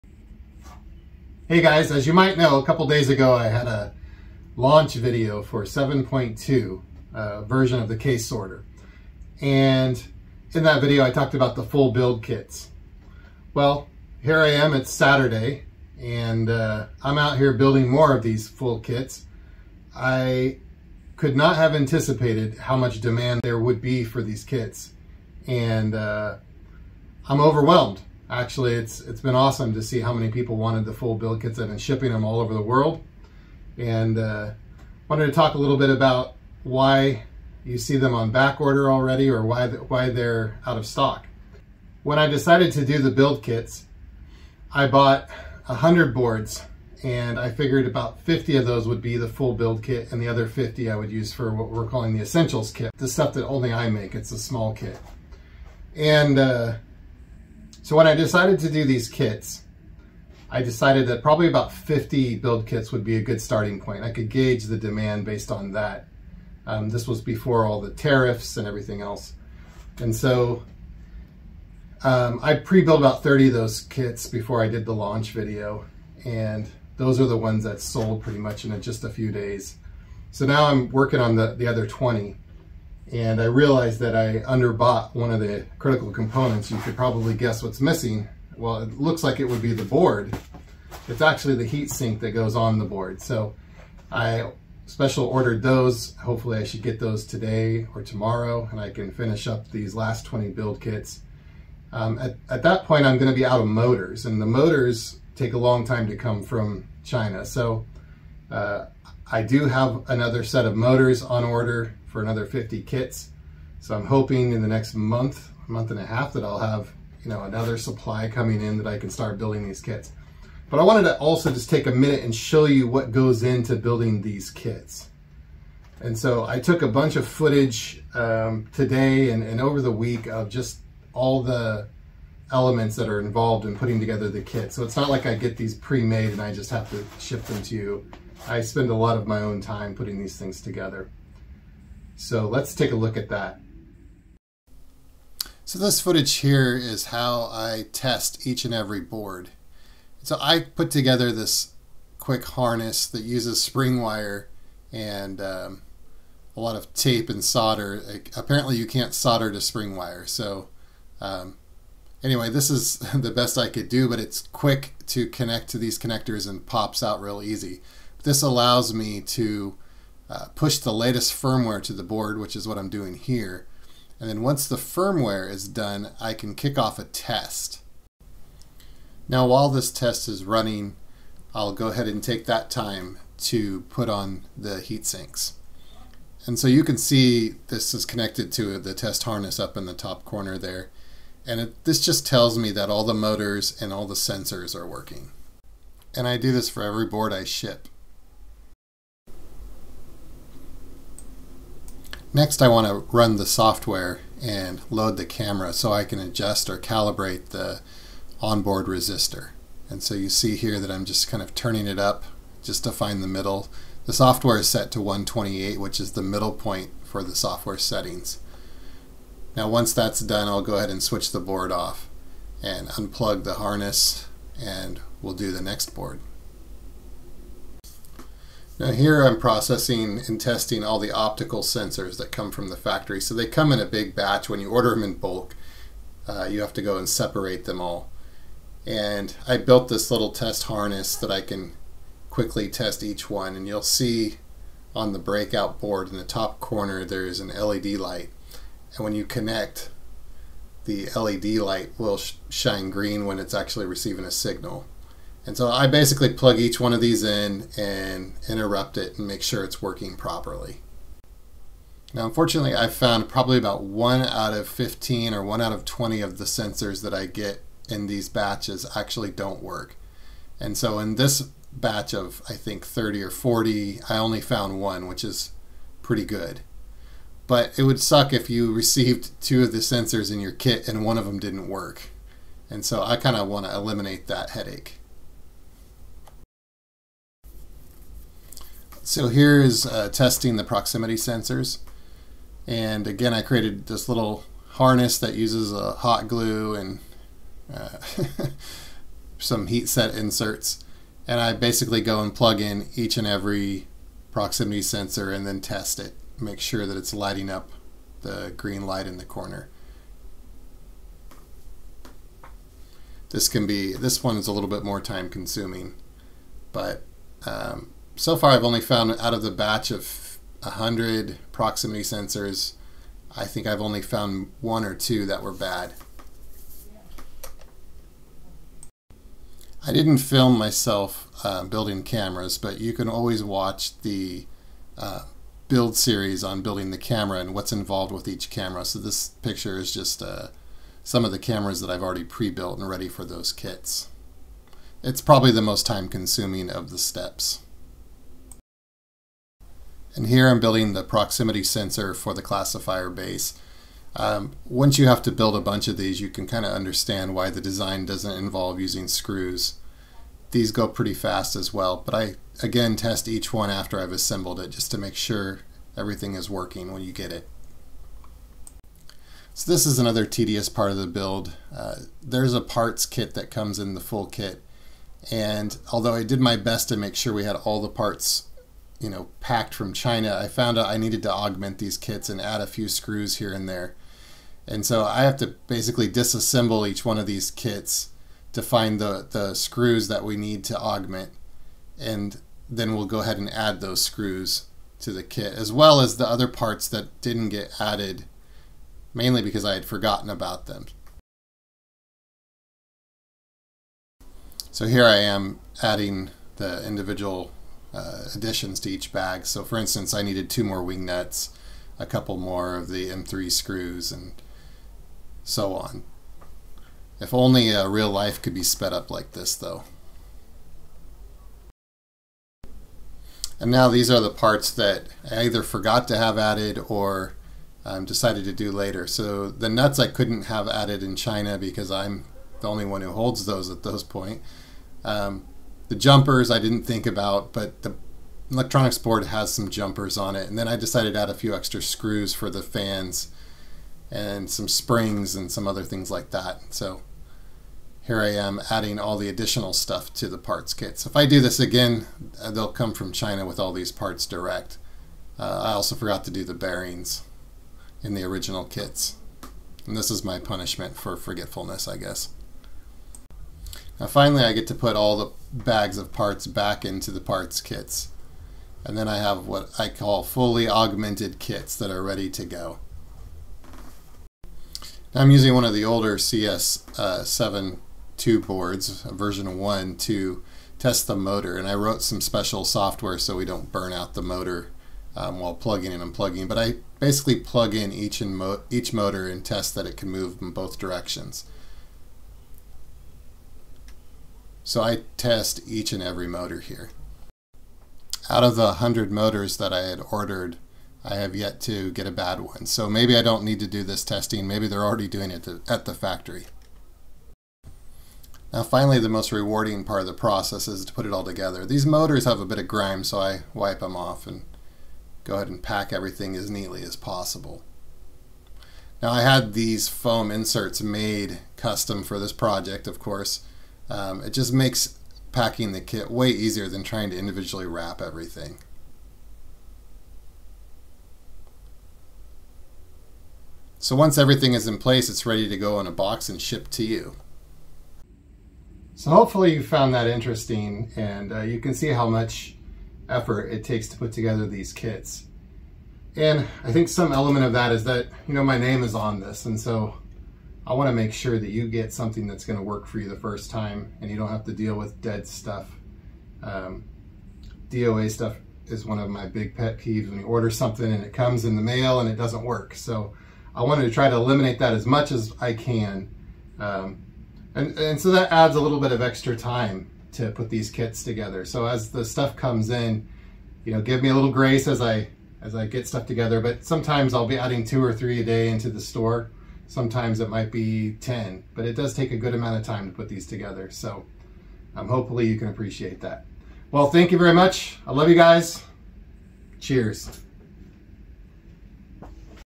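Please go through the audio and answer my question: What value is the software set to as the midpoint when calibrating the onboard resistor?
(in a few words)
128.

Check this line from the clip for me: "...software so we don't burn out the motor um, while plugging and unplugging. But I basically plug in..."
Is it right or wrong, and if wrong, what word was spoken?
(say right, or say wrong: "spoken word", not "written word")
right.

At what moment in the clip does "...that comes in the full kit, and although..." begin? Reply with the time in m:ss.
6:13.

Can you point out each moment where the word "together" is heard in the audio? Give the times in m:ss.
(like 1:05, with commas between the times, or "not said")
2:13, 2:20, 2:30, 8:31, 9:04, 9:31, 9:36, 9:43.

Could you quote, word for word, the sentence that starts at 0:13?
Well, here I am, it's Saturday, and uh, I'm out here building more of these full kits.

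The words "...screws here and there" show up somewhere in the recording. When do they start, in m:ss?
6:22.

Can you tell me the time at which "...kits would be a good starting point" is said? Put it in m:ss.
1:02.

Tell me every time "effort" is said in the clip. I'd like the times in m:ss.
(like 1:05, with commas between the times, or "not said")
9:03.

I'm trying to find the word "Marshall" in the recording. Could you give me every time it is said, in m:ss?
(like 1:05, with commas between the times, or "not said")
not said.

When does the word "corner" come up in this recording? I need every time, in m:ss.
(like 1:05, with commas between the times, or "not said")
3:10, 4:06, 5:09.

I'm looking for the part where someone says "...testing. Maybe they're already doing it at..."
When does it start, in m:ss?
8:24.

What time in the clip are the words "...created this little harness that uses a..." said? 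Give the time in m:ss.
4:53.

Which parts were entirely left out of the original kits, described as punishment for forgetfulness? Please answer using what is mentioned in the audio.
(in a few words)
bearings.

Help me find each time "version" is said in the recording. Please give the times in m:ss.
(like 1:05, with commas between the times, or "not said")
0:07, 7:59.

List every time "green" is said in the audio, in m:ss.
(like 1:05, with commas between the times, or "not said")
4:12, 5:08.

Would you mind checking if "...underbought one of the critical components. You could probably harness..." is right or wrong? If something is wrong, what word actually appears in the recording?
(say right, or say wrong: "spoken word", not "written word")
wrong: "guess", not "harness".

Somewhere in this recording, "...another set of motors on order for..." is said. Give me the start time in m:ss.
1:50.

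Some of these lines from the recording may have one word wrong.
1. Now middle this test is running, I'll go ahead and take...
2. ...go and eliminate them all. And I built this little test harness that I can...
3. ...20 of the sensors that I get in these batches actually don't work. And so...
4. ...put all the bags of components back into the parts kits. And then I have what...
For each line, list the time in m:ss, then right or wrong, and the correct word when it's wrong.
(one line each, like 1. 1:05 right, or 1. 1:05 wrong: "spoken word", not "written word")
1. 2:59 wrong: "while", not "middle"
2. 3:56 wrong: "separate", not "eliminate"
3. 4:25 right
4. 7:44 wrong: "parts", not "components".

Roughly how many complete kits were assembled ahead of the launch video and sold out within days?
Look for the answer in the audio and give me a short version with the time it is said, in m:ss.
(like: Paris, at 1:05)
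30, at 1:12.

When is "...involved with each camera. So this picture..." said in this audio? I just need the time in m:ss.
5:37.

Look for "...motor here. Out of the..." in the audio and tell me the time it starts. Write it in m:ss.
8:16.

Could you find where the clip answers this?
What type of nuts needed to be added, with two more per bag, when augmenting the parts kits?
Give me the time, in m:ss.
6:50.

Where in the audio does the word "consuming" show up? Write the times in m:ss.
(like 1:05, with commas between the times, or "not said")
5:15, 5:46.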